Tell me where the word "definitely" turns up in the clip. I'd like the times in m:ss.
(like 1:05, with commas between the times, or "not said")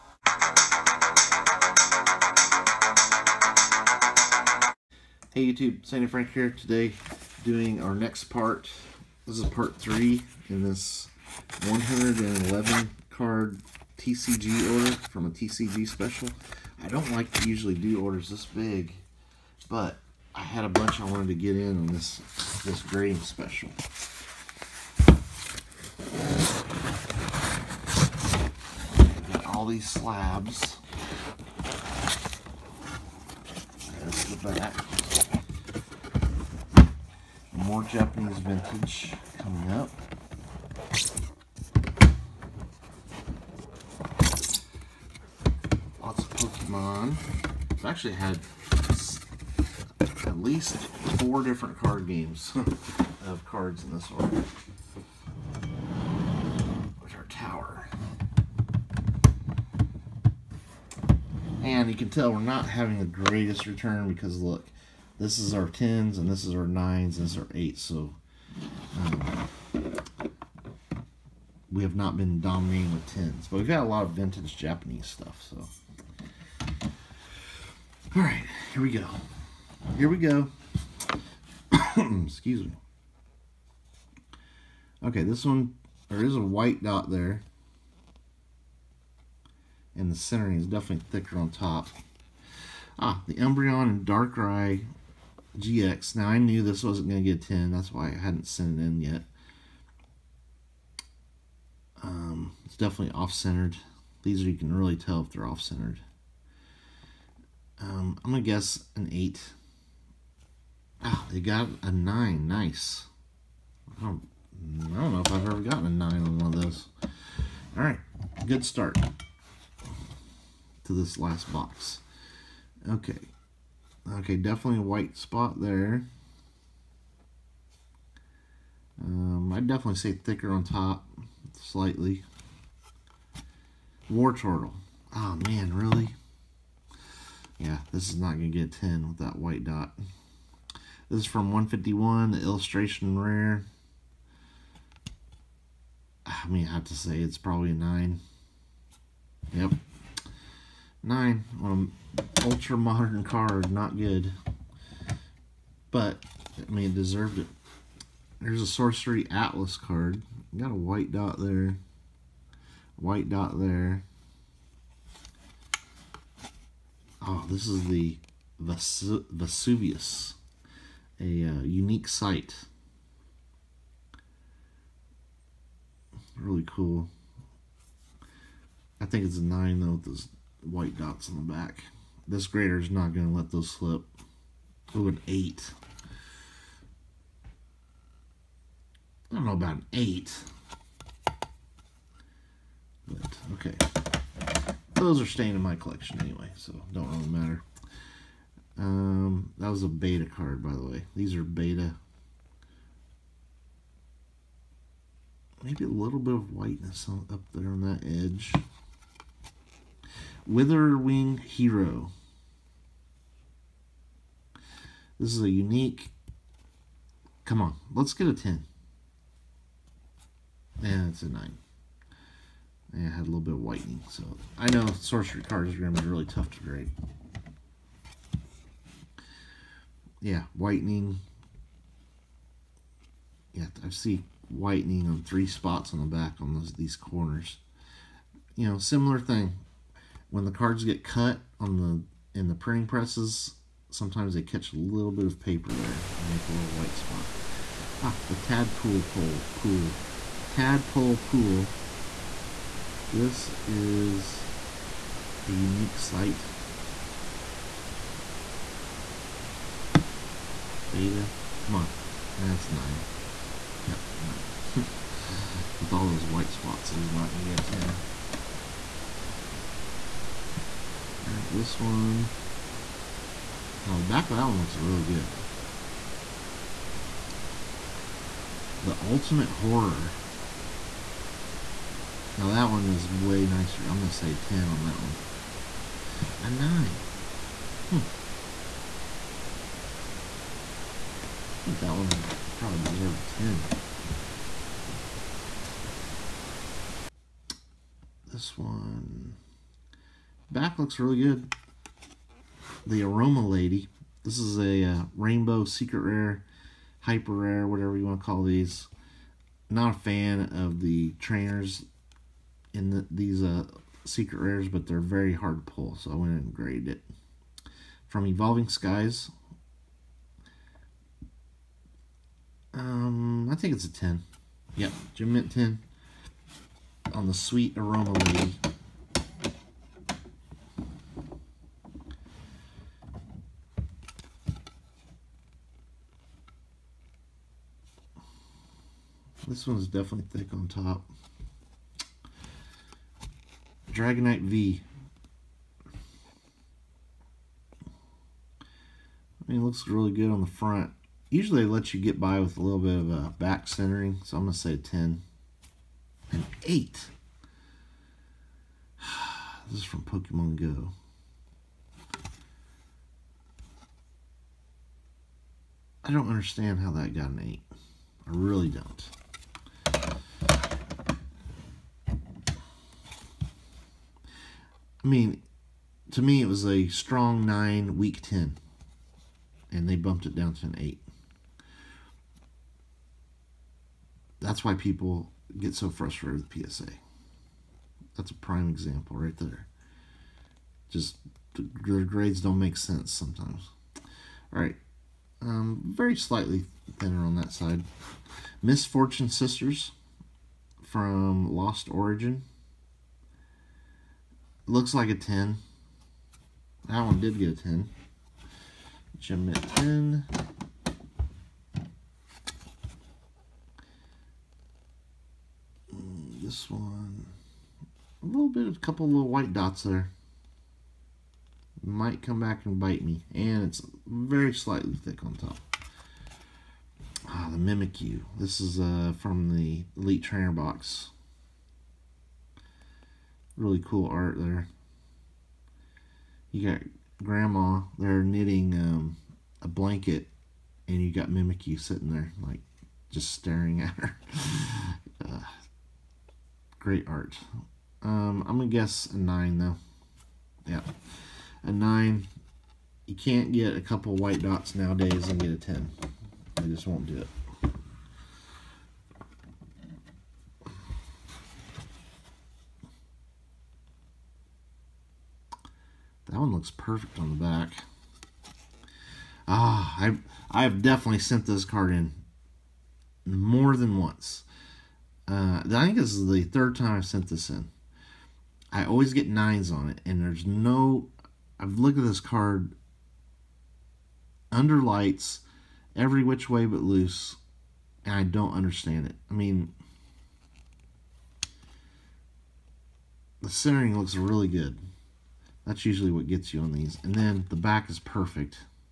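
1:30, 1:42, 2:04, 2:09, 5:39, 7:50.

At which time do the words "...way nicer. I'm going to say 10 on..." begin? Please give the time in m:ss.
4:43.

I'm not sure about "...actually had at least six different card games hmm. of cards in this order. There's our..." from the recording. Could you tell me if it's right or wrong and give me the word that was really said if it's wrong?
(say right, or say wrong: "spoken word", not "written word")
wrong: "four", not "six".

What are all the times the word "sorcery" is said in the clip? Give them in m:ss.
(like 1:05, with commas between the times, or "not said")
2:38, 3:44.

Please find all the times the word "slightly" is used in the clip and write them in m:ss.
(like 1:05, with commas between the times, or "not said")
2:11, 6:36, 7:04.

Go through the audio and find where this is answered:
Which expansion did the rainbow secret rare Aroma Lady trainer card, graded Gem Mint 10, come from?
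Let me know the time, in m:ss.
5:18.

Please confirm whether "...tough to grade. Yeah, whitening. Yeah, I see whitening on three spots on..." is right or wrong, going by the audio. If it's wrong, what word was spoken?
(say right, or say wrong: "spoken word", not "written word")
right.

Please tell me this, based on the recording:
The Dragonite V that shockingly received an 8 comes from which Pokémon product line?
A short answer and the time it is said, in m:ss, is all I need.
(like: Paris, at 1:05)
Pokemon Go, at 6:00.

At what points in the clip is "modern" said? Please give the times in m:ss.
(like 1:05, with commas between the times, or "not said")
2:32.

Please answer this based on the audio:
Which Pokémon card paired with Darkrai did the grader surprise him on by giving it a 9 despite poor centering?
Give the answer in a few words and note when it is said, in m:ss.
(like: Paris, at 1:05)
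Umbreon, at 1:33.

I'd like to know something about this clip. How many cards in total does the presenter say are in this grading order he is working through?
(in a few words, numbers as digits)
111.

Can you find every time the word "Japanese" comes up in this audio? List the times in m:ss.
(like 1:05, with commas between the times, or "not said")
0:37, 1:14.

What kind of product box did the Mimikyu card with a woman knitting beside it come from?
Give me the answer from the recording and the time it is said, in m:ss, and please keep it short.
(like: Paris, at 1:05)
Elite Trainer box, at 7:09.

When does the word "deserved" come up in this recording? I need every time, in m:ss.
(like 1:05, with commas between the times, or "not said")
2:36, 4:52.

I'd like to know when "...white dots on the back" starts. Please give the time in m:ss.
3:00.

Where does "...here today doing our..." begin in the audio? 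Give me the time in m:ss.
0:06.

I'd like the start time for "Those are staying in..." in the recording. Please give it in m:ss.
3:14.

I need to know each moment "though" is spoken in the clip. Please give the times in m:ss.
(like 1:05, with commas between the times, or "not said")
2:59, 7:29.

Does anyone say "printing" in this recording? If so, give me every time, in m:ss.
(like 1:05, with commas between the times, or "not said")
4:02.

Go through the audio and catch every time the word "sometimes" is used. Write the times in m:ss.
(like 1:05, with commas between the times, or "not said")
4:03, 6:33.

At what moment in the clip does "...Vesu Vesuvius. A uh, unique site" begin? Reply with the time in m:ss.
2:48.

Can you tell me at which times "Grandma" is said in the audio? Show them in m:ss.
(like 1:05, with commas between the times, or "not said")
7:17.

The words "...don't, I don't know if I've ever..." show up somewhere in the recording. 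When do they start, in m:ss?
1:54.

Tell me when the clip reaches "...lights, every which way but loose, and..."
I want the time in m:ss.
8:04.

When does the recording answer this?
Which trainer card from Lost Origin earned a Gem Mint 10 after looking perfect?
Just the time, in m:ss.
6:38.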